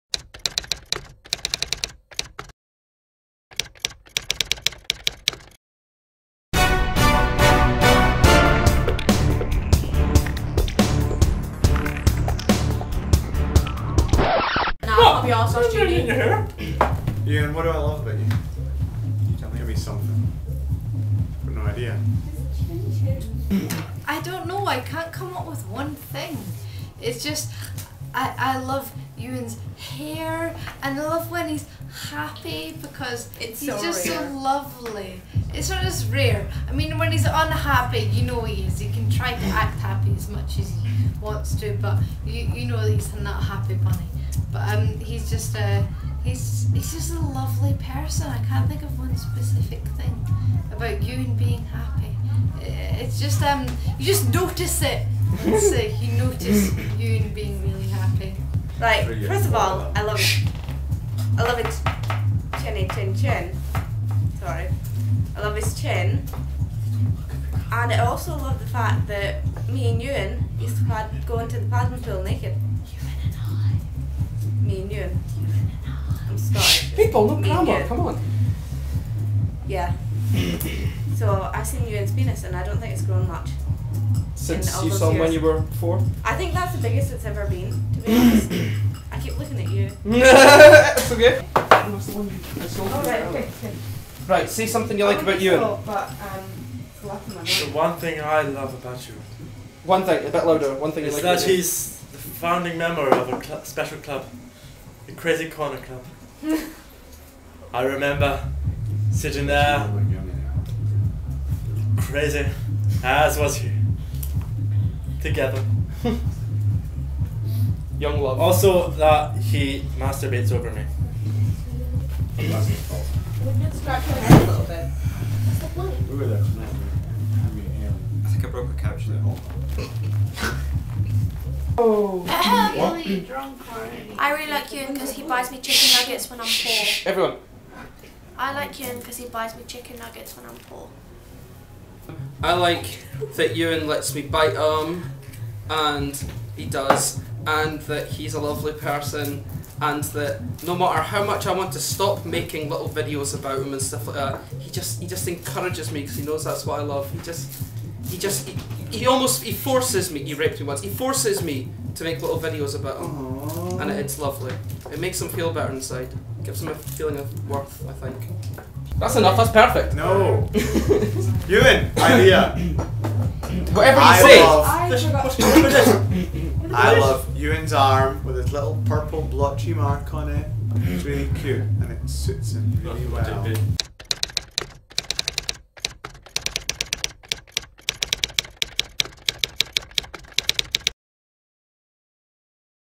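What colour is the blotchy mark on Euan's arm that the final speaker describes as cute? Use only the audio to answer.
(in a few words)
purple.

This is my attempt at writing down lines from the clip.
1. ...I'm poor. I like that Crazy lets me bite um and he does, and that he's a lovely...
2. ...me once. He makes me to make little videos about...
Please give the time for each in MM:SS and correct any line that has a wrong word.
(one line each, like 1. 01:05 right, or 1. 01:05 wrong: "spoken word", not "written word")
1. 02:20 wrong: "Euan", not "Crazy"
2. 02:40 wrong: "forces", not "makes".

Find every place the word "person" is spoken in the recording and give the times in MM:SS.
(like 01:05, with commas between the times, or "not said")
00:47, 02:28.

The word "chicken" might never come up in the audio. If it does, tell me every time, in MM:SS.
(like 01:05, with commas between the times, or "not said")
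02:15, 02:19.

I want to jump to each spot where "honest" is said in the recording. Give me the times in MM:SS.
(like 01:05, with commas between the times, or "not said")
00:15, 01:28.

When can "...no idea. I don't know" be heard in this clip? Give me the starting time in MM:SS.
00:21.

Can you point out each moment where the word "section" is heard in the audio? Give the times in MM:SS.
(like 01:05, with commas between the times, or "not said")
not said.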